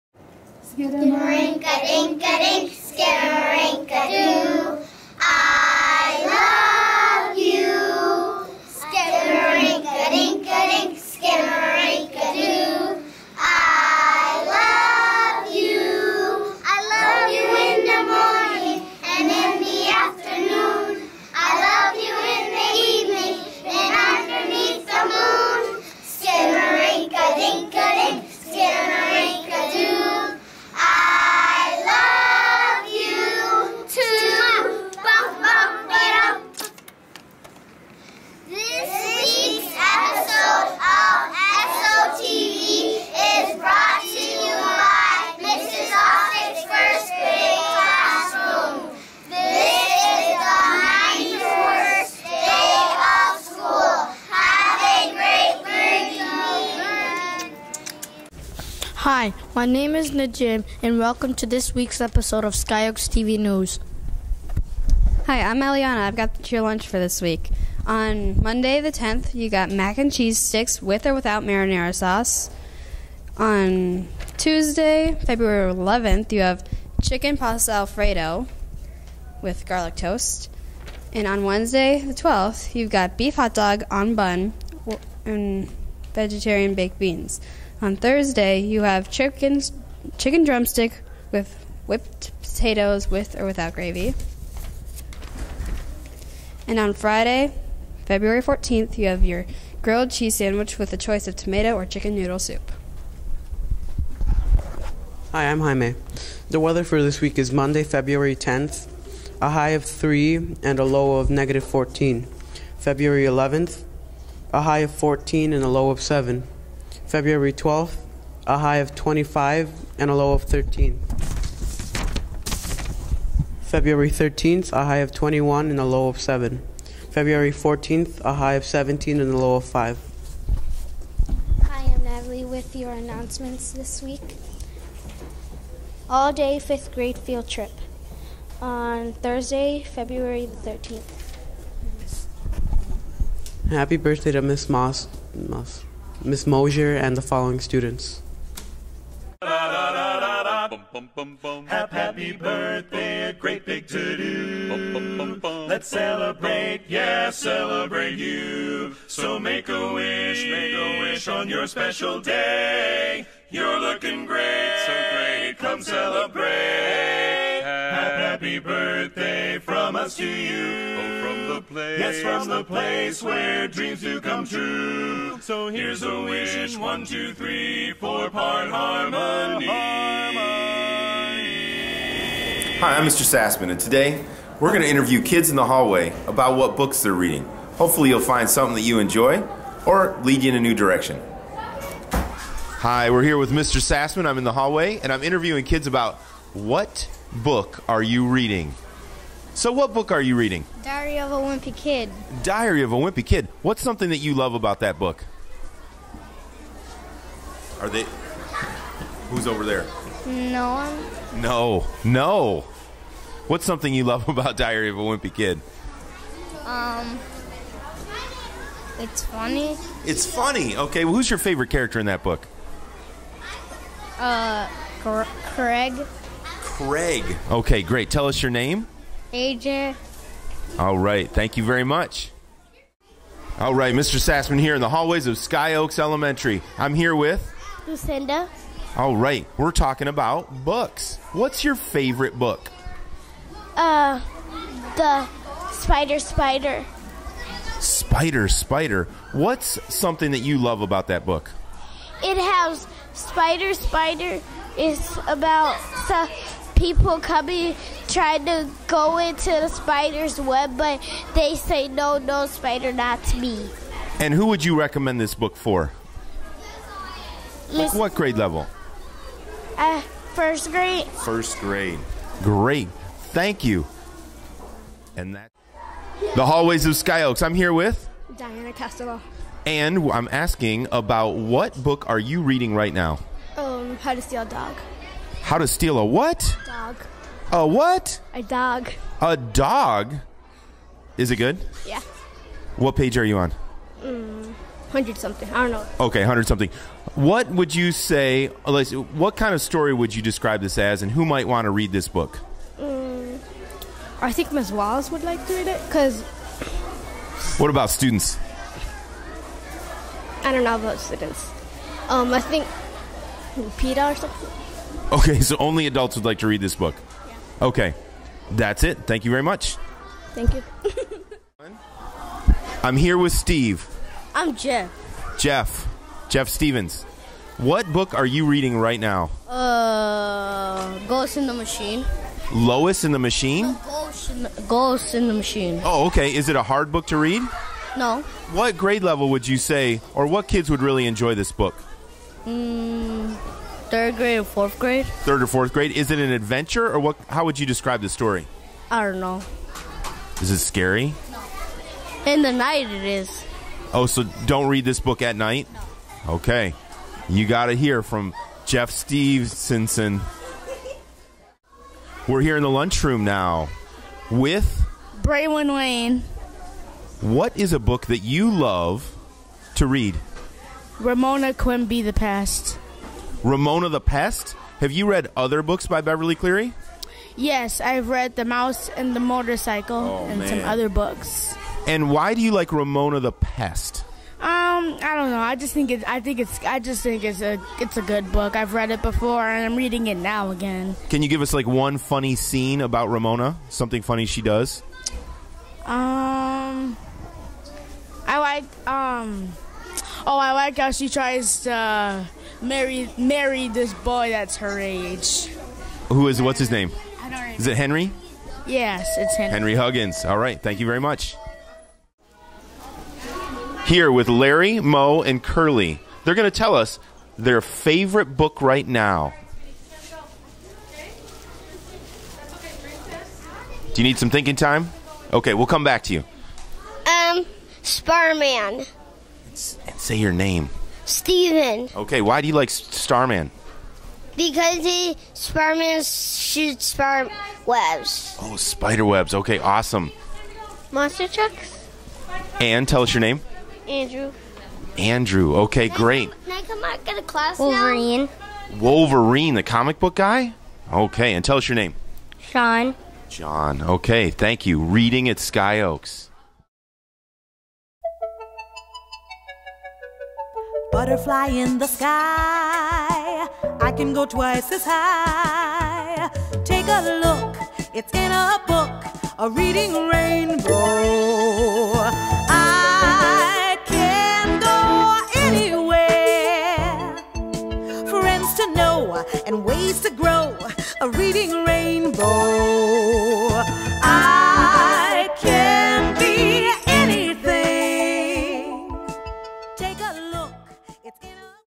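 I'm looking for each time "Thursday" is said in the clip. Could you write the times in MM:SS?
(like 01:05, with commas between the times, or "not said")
01:27, 02:19.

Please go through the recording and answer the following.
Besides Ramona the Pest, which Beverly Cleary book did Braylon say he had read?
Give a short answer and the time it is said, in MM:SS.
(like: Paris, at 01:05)
The Mouse and the Motorcycle, at 06:18.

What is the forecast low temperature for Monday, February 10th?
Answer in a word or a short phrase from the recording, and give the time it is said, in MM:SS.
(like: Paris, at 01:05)
-14, at 01:51.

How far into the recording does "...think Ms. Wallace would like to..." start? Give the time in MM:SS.
05:04.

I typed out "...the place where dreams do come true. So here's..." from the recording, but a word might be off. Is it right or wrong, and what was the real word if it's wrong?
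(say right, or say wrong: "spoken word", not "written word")
right.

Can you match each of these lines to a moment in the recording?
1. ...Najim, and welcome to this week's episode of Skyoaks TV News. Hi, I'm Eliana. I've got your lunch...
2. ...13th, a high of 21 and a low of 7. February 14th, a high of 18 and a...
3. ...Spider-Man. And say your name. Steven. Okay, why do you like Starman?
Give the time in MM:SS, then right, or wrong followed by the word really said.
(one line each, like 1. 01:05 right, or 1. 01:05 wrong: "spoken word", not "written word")
1. 01:00 right
2. 02:04 wrong: "17", not "18"
3. 07:07 right.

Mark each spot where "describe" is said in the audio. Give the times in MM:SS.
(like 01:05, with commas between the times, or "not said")
05:00, 05:47.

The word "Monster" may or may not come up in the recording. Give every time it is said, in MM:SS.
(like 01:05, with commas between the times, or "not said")
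07:20.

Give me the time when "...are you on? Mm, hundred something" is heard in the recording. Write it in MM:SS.
04:53.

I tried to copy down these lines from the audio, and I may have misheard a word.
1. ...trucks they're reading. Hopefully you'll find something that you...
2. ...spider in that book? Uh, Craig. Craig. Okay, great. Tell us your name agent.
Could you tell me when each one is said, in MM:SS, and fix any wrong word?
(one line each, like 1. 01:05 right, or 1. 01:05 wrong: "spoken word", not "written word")
1. 03:06 wrong: "books", not "trucks"
2. 03:41 wrong: "character", not "spider".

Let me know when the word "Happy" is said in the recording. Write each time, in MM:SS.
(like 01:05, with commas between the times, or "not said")
02:23, 02:29, 02:47.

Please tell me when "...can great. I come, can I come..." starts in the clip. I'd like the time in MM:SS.
07:25.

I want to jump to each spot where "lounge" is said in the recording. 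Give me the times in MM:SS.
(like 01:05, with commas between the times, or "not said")
not said.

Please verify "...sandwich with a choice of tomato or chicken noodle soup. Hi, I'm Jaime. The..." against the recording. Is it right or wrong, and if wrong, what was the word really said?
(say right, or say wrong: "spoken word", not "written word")
right.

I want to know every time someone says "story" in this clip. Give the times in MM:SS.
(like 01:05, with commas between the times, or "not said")
04:59, 05:48.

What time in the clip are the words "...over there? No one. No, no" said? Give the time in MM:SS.
03:29.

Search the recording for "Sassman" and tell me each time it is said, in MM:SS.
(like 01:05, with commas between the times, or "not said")
03:03, 03:13, 03:54.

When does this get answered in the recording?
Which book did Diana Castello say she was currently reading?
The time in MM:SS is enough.
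04:43.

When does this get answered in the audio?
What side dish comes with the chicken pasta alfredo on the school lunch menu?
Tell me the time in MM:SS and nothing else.
01:19.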